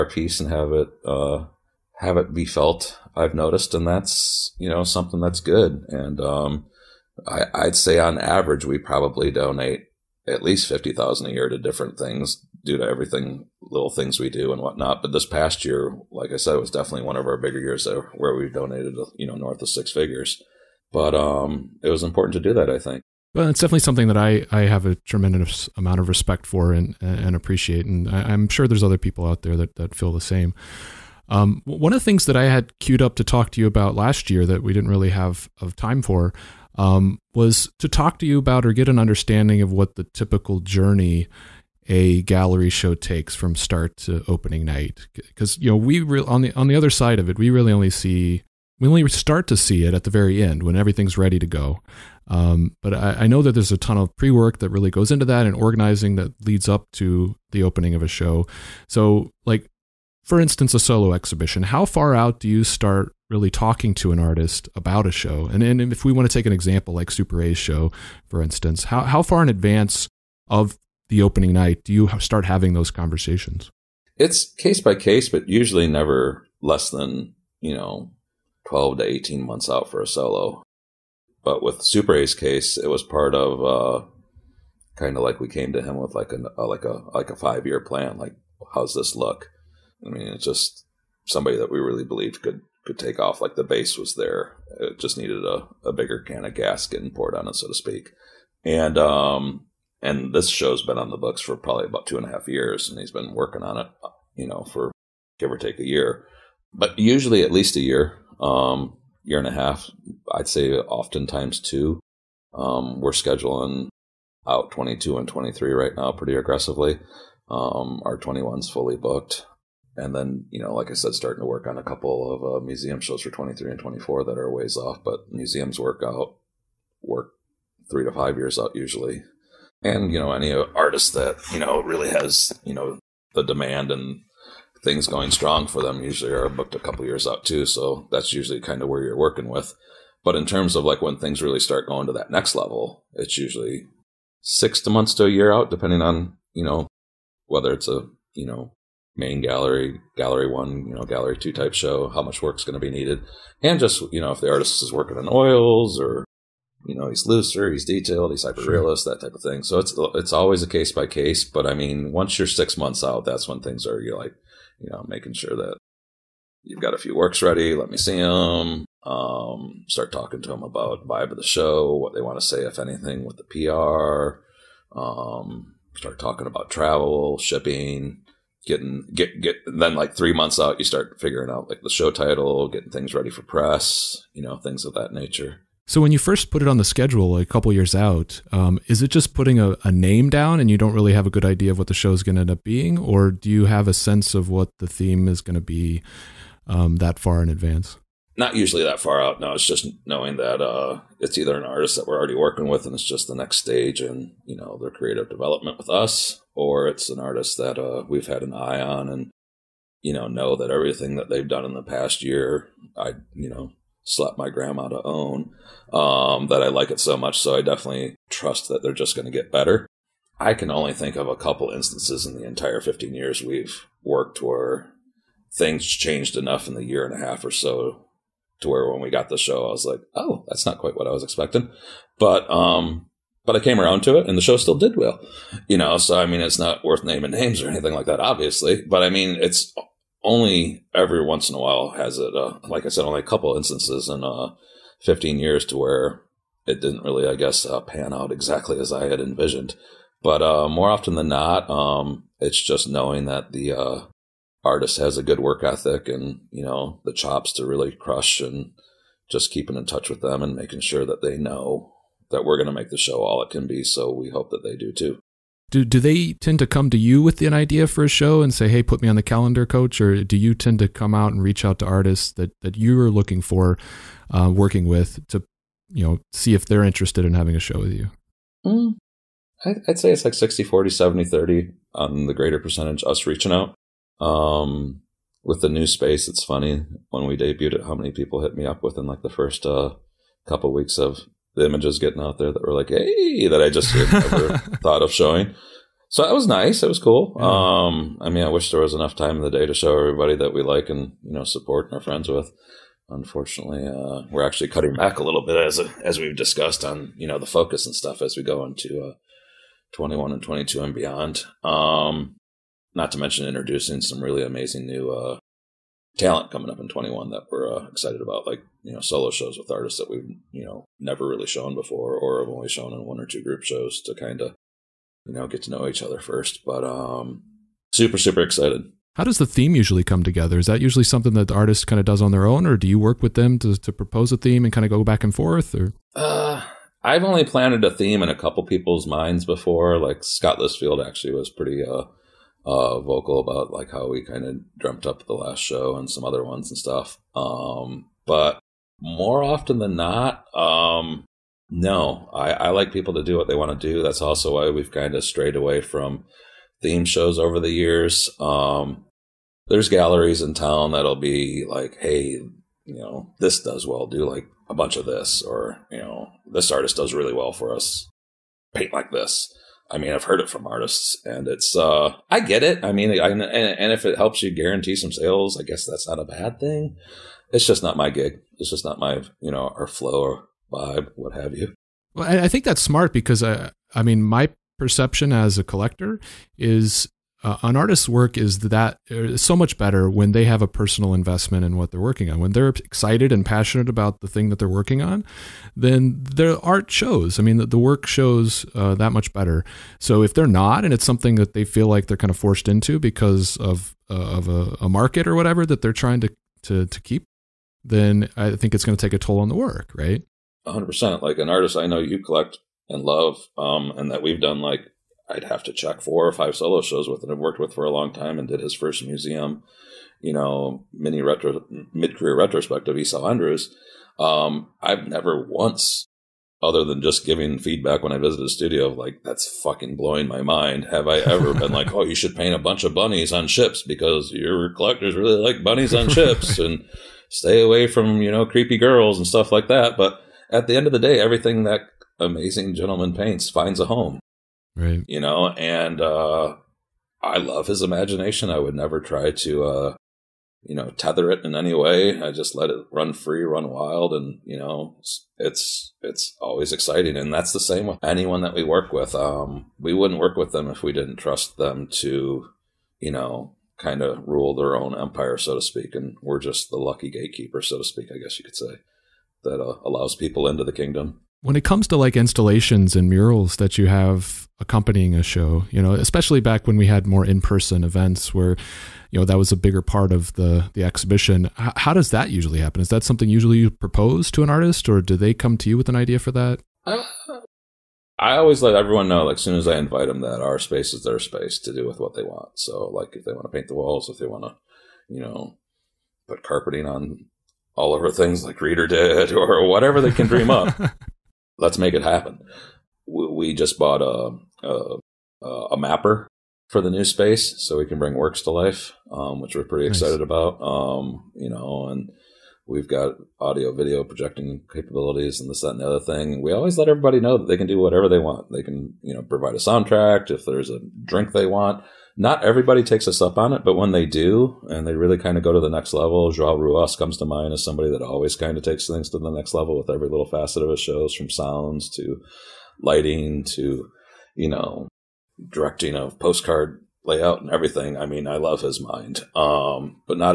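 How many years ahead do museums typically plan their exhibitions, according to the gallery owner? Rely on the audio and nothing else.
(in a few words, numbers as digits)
3 to 5 years.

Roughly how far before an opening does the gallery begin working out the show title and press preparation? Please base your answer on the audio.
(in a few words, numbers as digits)
3 months.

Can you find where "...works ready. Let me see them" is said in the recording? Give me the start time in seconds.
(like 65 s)
167 s.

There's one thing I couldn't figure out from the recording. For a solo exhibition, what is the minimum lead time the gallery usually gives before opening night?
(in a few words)
12 to 18 months.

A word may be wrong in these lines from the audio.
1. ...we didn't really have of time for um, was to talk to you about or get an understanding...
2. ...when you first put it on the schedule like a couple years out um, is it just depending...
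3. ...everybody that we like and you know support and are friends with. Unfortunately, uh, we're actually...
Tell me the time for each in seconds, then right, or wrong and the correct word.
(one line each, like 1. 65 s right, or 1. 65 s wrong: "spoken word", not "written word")
1. 34 s right
2. 186 s wrong: "putting", not "depending"
3. 299 s right.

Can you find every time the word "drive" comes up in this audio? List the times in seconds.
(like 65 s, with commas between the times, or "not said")
not said.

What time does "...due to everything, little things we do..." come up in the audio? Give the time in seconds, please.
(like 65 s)
12 s.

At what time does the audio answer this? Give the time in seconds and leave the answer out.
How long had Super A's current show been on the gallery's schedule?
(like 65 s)
102 s.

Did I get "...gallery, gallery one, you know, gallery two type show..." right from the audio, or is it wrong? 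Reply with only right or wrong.
right.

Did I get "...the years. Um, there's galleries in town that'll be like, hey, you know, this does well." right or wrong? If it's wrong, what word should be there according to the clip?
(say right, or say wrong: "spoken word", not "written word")
right.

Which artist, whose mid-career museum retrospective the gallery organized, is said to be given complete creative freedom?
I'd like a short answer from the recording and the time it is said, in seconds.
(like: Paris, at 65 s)
Esao Andrews, at 422 s.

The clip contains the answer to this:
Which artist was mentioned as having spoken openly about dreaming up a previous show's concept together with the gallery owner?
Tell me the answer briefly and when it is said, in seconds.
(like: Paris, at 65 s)
Scott Listfield, at 340 s.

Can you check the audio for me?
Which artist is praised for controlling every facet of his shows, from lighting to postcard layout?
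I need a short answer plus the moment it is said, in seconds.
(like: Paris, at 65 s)
João Ruas, at 526 s.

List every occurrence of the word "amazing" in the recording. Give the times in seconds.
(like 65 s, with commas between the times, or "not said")
314 s, 442 s.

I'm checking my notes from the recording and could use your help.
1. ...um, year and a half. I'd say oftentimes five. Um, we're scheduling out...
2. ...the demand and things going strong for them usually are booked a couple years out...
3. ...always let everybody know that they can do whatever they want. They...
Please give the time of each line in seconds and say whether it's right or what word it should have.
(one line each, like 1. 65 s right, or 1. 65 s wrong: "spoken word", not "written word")
1. 108 s wrong: "two", not "five"
2. 133 s right
3. 516 s right.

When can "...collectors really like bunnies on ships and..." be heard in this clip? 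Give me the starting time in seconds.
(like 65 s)
434 s.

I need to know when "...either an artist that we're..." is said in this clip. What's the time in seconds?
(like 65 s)
201 s.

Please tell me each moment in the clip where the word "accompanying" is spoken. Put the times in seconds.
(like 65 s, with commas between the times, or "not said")
474 s.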